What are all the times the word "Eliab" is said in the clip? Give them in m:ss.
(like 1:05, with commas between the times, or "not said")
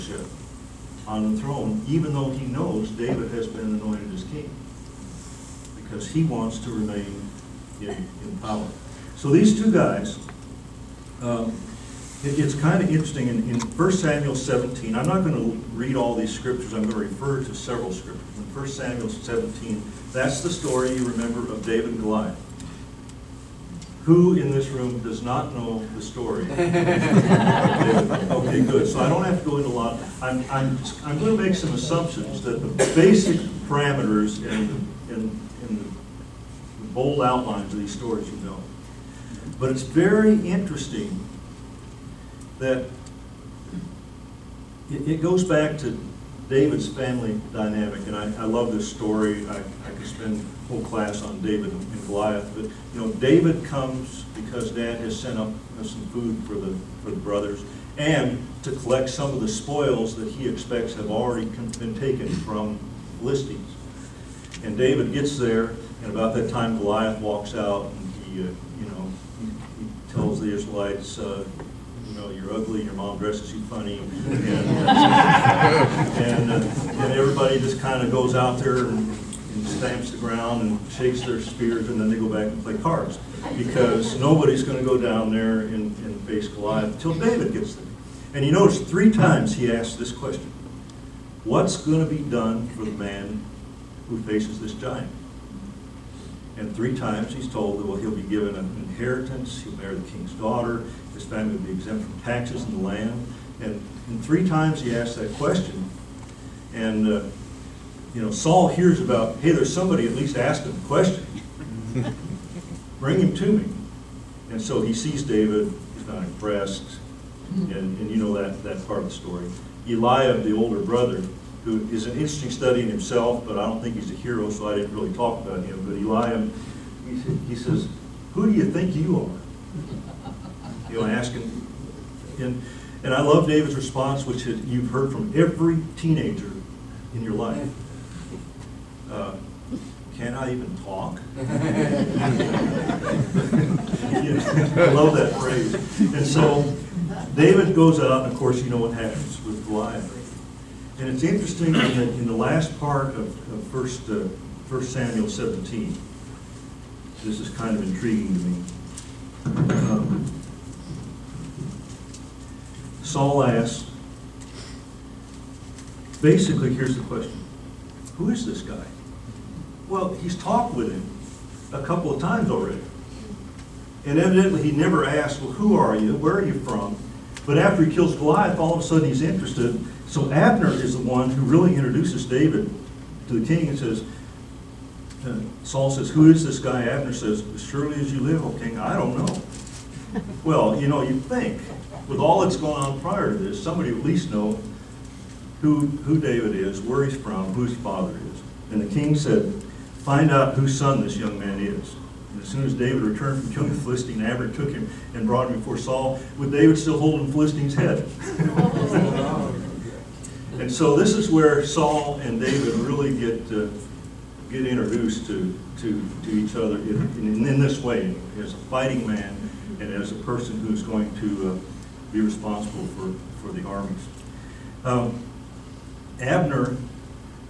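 1:59, 2:05.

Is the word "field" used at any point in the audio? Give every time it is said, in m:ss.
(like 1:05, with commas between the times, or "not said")
not said.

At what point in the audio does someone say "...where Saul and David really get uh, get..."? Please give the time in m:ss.
3:31.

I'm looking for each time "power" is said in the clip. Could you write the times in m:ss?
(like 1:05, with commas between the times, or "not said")
0:08.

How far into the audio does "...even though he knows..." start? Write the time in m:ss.
0:01.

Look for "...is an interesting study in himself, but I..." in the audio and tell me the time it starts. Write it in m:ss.
2:01.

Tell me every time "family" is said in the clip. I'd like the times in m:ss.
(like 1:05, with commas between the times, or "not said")
0:46, 1:41.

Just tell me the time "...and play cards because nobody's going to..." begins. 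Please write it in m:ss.
1:22.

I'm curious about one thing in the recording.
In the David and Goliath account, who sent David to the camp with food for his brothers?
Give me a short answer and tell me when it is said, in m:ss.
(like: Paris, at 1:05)
Dad, at 0:54.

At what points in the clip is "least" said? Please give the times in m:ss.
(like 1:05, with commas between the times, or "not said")
1:50, 3:14.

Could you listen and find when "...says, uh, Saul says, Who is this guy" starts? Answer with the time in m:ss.
3:03.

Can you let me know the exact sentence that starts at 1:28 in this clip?
And you notice three times he asks this question What's going to be done for the man who faces this giant?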